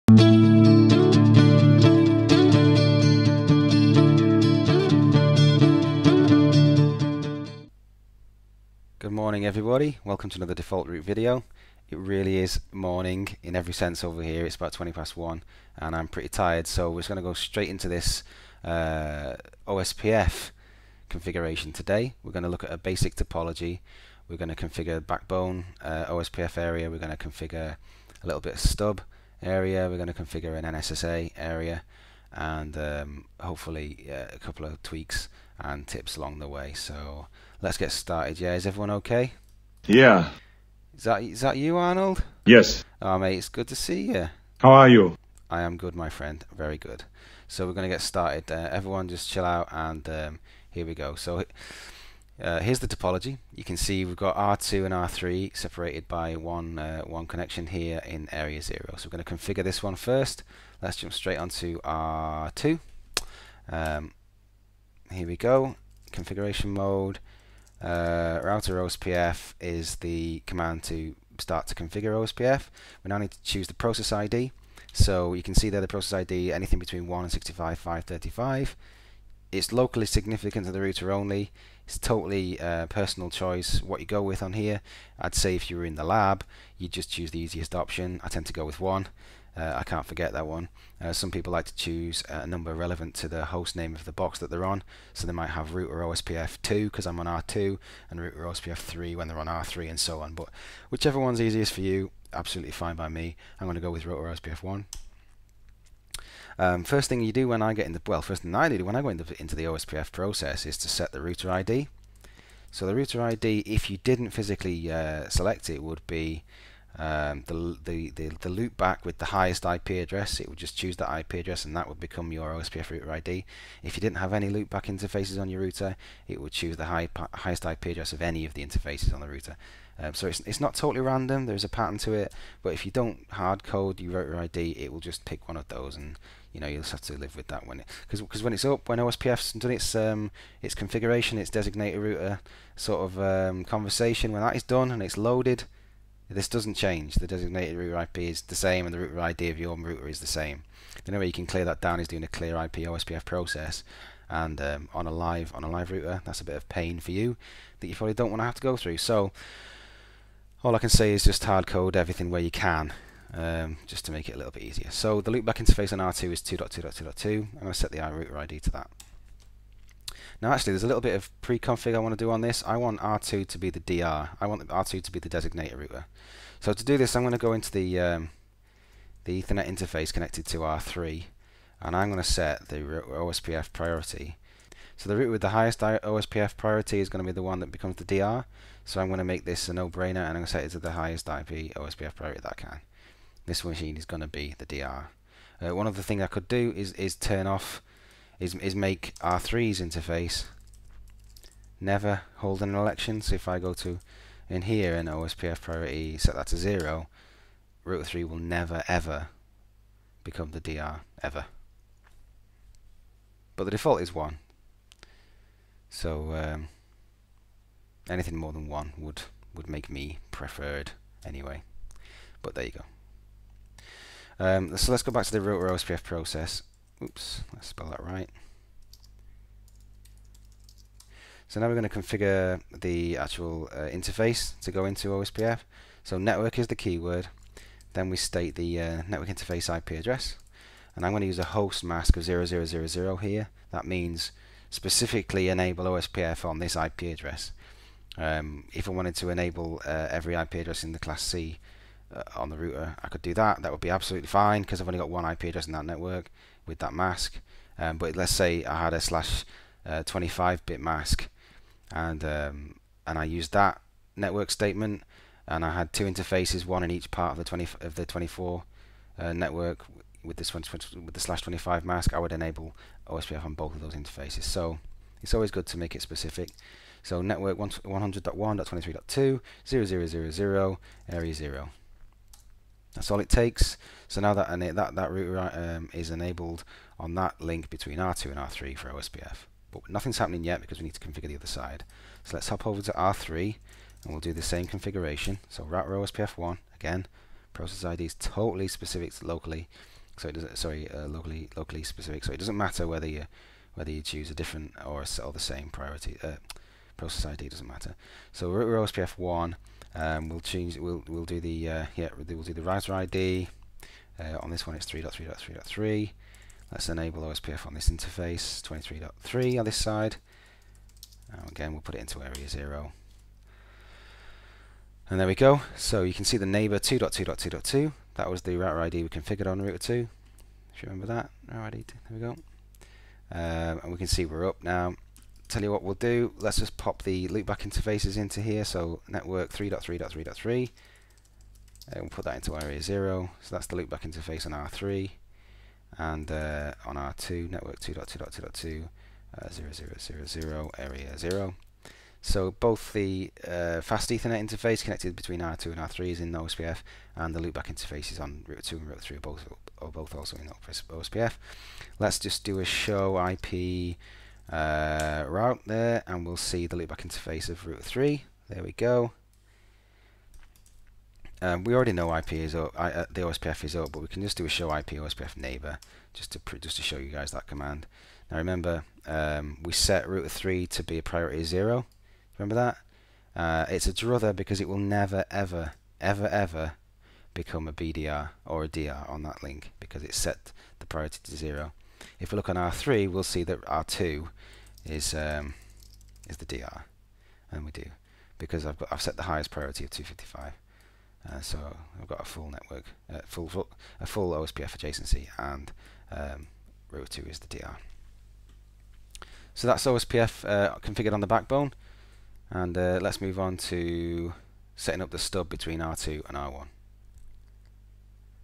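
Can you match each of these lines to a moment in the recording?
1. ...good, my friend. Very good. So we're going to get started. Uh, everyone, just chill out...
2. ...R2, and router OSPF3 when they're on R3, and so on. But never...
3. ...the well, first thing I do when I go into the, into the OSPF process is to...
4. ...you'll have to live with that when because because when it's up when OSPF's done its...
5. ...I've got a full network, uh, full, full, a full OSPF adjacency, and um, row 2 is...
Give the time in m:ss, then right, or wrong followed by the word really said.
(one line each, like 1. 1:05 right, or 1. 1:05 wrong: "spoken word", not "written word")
1. 0:45 right
2. 1:37 wrong: "whichever", not "never"
3. 1:47 right
4. 2:16 right
5. 6:42 right.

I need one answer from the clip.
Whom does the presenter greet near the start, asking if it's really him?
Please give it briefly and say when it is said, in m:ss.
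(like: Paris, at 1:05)
Arnold, at 0:41.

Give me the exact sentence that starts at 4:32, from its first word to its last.
I would enable OSPF on both of those interfaces.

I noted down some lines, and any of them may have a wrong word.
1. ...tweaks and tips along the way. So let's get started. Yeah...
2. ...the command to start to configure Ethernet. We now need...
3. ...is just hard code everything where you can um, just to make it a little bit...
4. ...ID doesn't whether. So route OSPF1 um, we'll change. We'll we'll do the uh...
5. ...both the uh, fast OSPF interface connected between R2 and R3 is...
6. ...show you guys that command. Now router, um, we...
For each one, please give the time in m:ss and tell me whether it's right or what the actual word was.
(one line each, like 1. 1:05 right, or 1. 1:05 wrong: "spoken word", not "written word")
1. 0:34 right
2. 1:09 wrong: "OSPF", not "Ethernet"
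3. 2:41 right
4. 5:07 wrong: "matter", not "whether"
5. 5:52 wrong: "Ethernet", not "OSPF"
6. 6:16 wrong: "remember", not "router".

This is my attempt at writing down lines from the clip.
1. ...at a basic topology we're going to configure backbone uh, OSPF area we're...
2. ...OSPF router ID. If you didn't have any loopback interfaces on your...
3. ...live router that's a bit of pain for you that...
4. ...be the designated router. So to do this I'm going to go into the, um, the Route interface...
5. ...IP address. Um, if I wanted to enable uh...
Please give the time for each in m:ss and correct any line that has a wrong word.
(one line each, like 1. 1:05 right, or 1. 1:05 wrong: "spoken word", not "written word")
1. 0:22 right
2. 2:02 right
3. 2:35 right
4. 2:55 wrong: "Ethernet", not "Route"
5. 4:06 right.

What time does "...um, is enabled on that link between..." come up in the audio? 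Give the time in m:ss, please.
4:45.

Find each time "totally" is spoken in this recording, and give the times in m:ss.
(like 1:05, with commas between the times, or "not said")
1:21, 2:10, 4:58.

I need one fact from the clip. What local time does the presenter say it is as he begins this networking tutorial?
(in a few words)
20 past 1.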